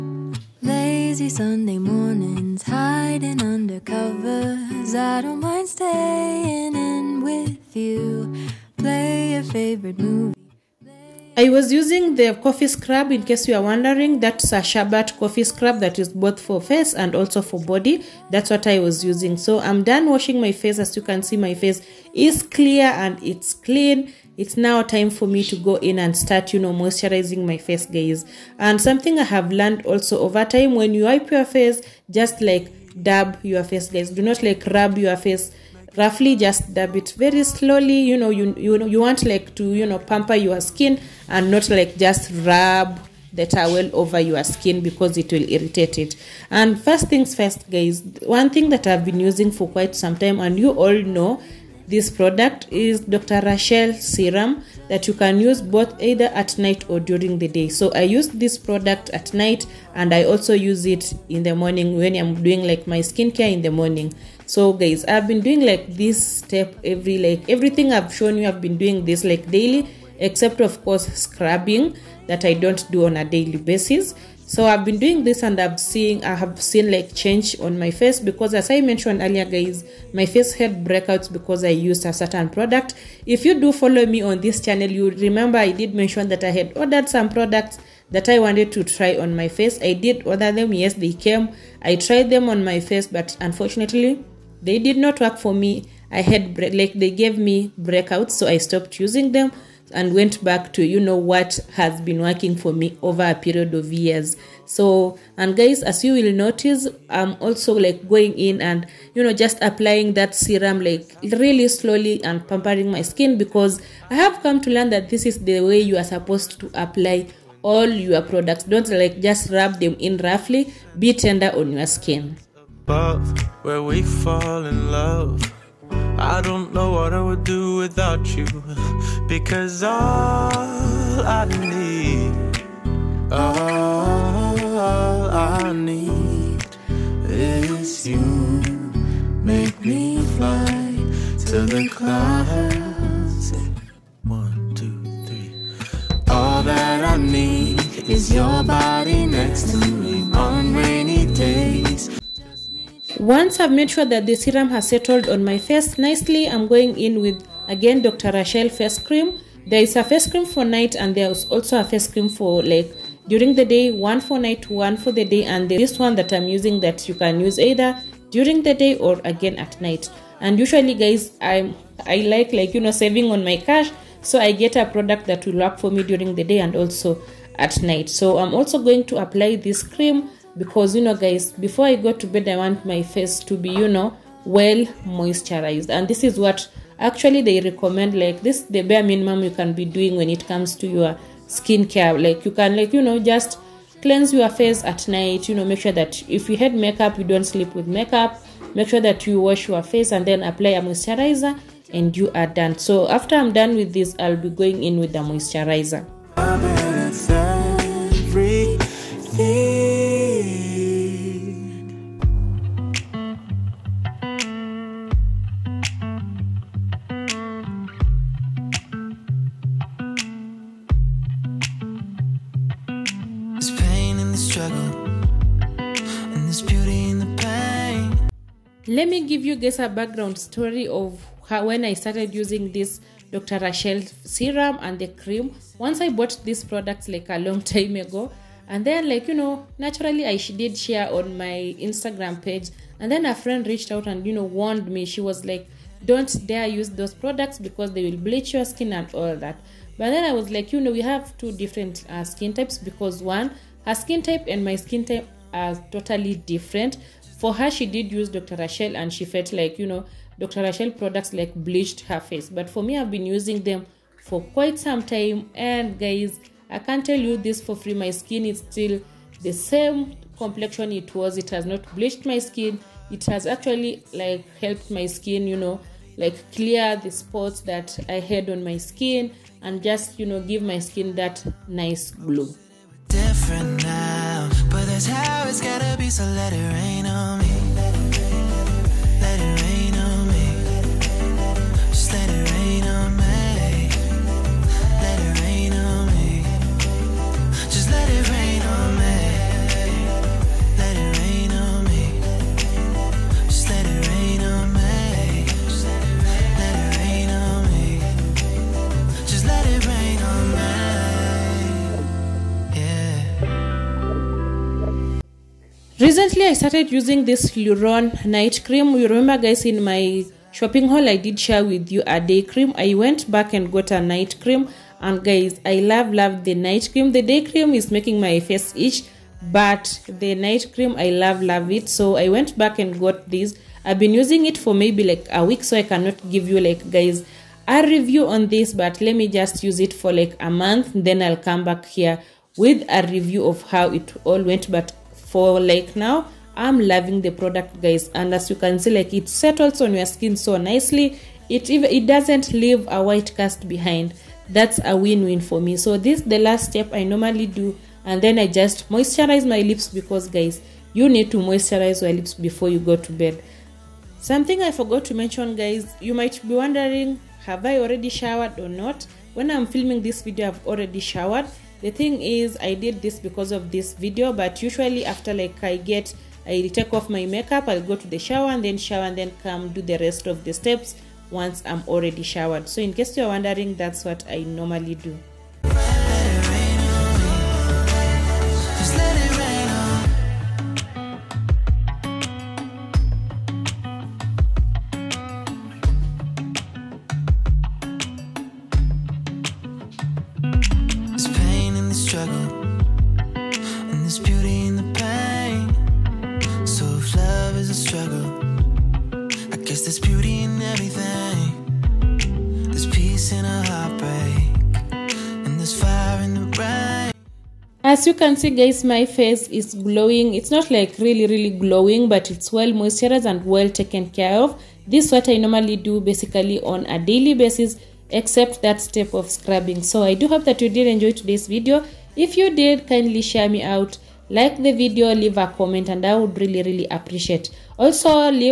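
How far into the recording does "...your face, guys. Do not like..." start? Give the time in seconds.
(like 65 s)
33 s.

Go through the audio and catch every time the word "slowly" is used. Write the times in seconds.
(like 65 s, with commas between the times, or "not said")
37 s, 111 s.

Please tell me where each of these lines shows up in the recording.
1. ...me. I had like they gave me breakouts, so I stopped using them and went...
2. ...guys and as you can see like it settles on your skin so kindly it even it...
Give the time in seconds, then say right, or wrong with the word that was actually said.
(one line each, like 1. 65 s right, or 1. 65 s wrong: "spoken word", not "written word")
1. 95 s right
2. 347 s wrong: "nicely", not "kindly".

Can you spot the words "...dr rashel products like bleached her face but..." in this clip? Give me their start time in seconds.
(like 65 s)
260 s.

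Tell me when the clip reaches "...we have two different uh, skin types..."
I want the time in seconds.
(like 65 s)
250 s.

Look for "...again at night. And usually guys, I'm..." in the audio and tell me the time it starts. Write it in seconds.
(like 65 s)
169 s.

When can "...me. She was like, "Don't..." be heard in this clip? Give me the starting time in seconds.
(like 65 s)
244 s.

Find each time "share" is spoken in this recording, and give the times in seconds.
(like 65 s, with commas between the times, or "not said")
240 s, 321 s, 433 s.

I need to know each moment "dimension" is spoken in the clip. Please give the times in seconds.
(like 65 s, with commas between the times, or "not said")
not said.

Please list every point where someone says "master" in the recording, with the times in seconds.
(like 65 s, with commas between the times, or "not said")
not said.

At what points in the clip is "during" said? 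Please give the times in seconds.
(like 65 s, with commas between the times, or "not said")
57 s, 163 s, 168 s, 176 s.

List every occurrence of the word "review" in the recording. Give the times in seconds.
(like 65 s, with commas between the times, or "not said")
337 s, 343 s.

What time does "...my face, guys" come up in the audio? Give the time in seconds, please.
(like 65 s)
27 s.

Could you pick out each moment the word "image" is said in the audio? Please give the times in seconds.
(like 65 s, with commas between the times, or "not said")
not said.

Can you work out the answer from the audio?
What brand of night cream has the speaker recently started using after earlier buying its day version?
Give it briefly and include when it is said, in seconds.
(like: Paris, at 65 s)
Luron, at 317 s.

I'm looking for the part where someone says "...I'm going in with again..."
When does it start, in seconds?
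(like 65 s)
156 s.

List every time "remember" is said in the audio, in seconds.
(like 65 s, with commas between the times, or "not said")
85 s, 319 s.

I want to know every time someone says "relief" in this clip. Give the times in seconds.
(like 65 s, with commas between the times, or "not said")
not said.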